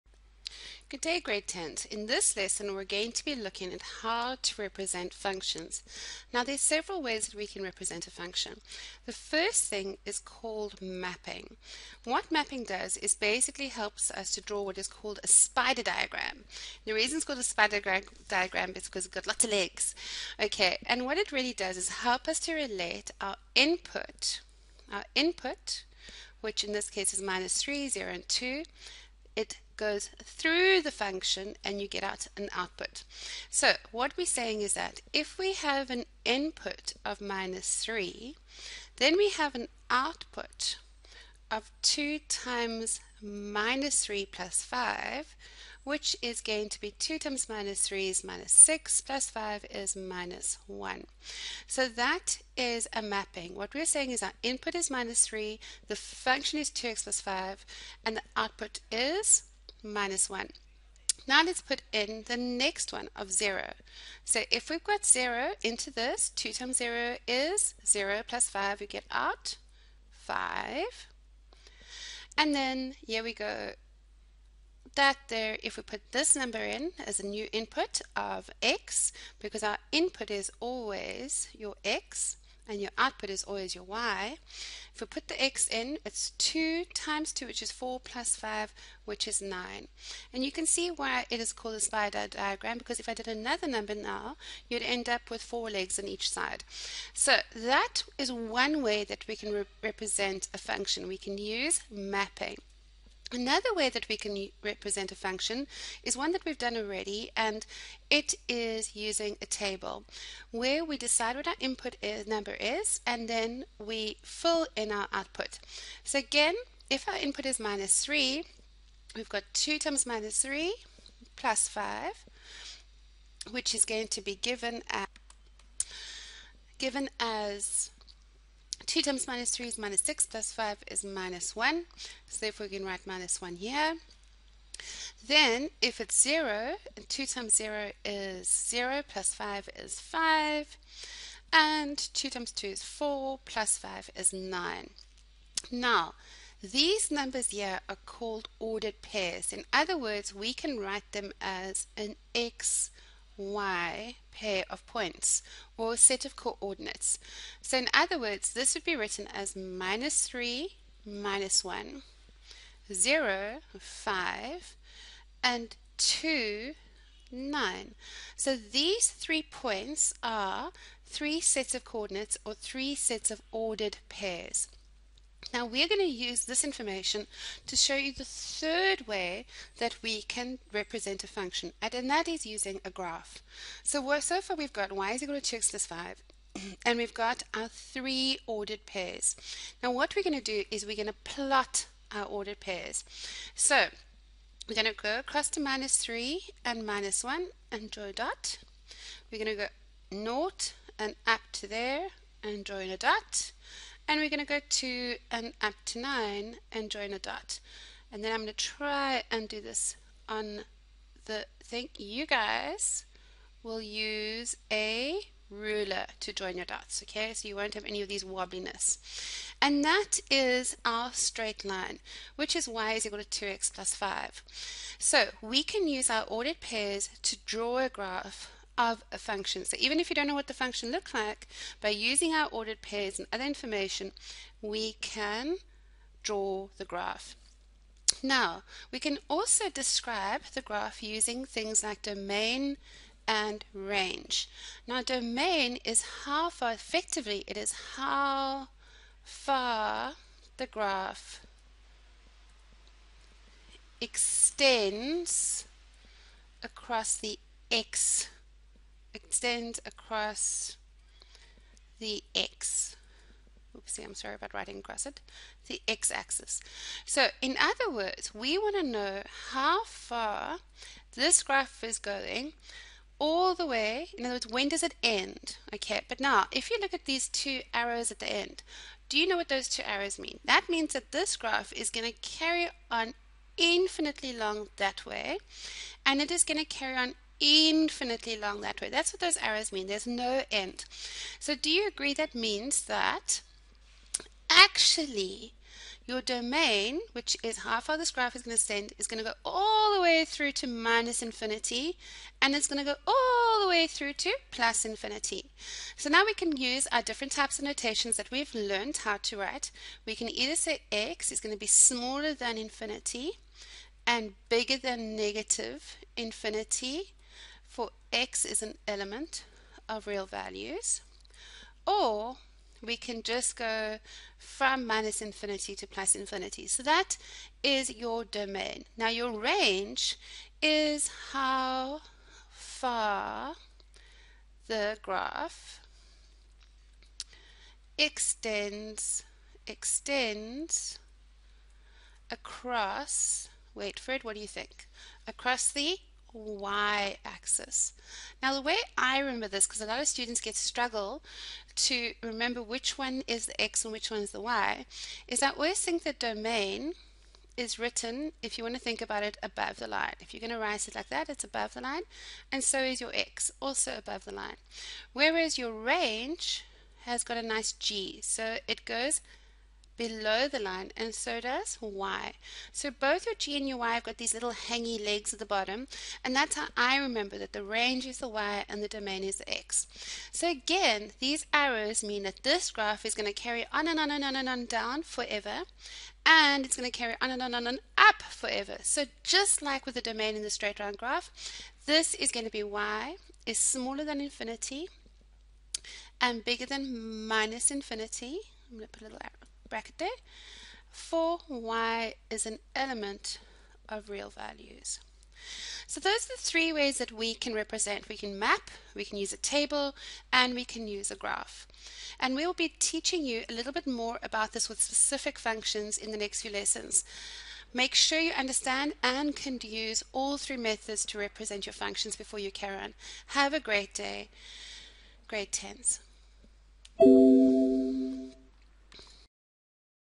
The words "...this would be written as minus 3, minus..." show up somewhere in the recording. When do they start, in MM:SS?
02:38.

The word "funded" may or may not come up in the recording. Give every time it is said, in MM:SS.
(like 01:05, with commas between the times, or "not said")
not said.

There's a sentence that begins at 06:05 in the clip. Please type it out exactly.
Whereas your range has got a nice g, so it goes below the line and so does y.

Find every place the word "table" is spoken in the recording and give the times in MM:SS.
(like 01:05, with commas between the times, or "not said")
01:49, 06:49.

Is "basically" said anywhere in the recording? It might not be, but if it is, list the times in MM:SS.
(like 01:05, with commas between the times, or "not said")
00:13.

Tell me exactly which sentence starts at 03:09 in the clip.
Now what we're going to do is we're going to plot our ordered pairs.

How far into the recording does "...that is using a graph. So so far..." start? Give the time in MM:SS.
03:02.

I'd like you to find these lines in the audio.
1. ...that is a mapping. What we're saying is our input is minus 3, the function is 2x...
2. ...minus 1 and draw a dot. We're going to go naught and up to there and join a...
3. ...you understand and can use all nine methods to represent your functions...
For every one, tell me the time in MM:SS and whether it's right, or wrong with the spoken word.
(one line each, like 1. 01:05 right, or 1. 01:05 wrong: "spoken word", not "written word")
1. 00:51 right
2. 03:16 right
3. 06:58 wrong: "three", not "nine".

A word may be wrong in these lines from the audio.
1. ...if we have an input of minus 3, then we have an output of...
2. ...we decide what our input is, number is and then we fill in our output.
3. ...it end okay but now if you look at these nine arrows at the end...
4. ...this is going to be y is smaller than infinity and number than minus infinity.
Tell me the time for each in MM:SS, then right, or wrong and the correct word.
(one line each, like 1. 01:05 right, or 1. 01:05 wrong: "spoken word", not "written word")
1. 00:35 right
2. 01:50 right
3. 04:34 wrong: "two", not "nine"
4. 06:31 wrong: "bigger", not "number".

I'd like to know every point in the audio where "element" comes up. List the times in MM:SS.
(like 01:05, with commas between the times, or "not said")
05:18, 06:42.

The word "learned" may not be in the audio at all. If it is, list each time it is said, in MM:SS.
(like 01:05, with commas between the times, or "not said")
05:08.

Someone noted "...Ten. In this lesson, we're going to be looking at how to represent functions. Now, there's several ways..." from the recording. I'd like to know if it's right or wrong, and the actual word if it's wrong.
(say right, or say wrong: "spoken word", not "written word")
right.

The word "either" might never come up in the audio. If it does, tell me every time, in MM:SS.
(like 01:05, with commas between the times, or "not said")
05:10.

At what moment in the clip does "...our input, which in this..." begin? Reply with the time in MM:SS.
00:24.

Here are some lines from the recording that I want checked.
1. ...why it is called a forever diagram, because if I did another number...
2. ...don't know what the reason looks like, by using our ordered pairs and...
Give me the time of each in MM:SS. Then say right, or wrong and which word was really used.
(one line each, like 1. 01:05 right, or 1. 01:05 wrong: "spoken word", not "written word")
1. 01:30 wrong: "spider", not "forever"
2. 03:50 wrong: "function", not "reason".